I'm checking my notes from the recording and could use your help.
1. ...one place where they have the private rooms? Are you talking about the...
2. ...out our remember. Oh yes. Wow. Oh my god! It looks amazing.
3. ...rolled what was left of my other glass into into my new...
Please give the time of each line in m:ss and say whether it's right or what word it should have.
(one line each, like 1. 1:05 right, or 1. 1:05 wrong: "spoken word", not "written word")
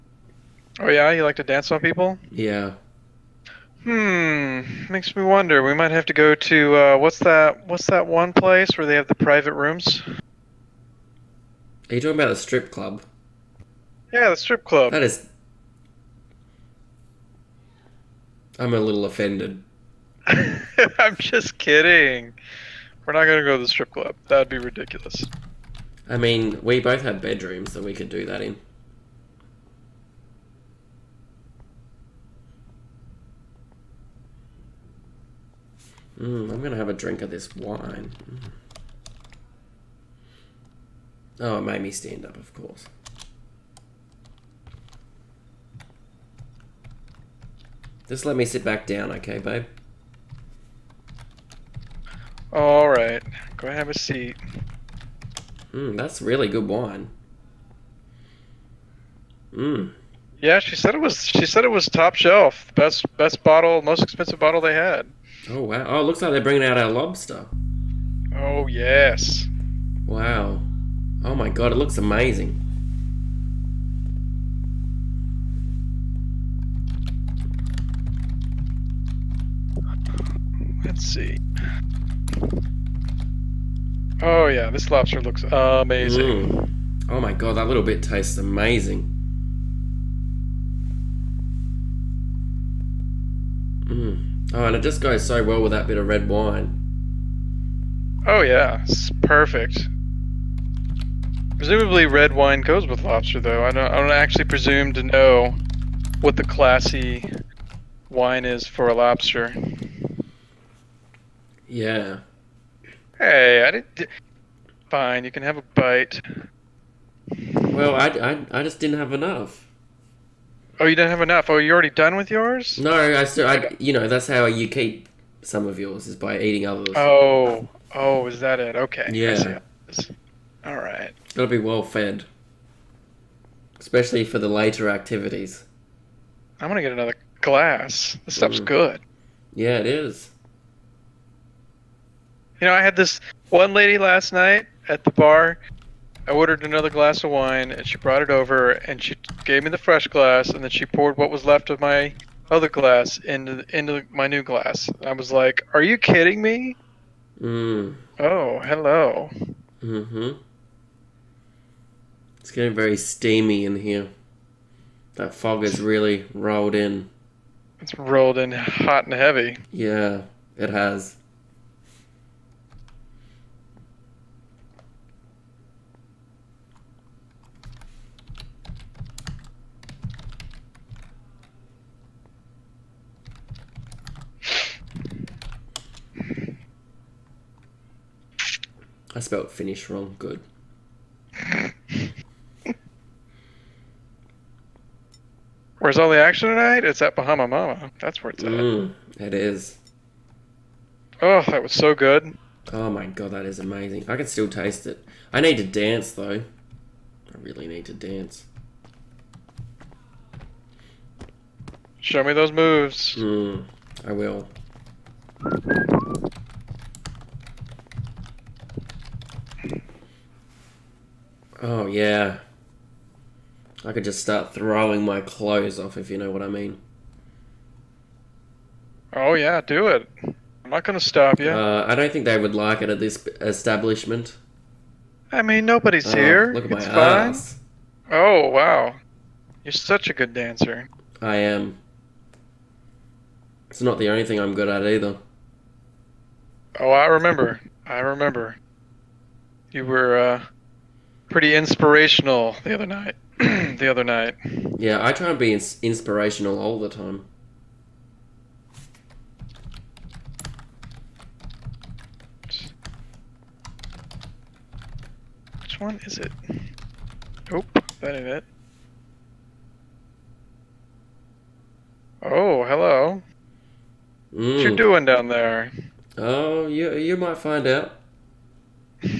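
1. 0:08 right
2. 1:06 wrong: "lobster", not "remember"
3. 2:30 wrong: "poured", not "rolled".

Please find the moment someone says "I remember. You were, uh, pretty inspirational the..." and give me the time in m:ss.
4:07.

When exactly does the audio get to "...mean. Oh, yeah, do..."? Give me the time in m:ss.
3:46.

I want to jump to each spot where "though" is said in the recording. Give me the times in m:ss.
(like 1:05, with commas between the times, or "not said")
1:43, 3:26.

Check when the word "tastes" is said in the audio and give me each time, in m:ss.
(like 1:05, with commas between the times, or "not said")
1:28, 3:24.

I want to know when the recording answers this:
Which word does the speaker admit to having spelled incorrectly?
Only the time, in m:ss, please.
3:09.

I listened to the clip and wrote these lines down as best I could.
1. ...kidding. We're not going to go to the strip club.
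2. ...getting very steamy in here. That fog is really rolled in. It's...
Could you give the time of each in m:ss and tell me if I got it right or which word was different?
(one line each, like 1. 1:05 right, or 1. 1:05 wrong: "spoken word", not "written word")
1. 0:21 right
2. 2:42 right.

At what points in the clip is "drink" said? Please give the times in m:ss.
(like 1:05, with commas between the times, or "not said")
0:36.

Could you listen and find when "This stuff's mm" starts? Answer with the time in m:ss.
2:18.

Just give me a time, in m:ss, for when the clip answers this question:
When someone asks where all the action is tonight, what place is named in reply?
3:17.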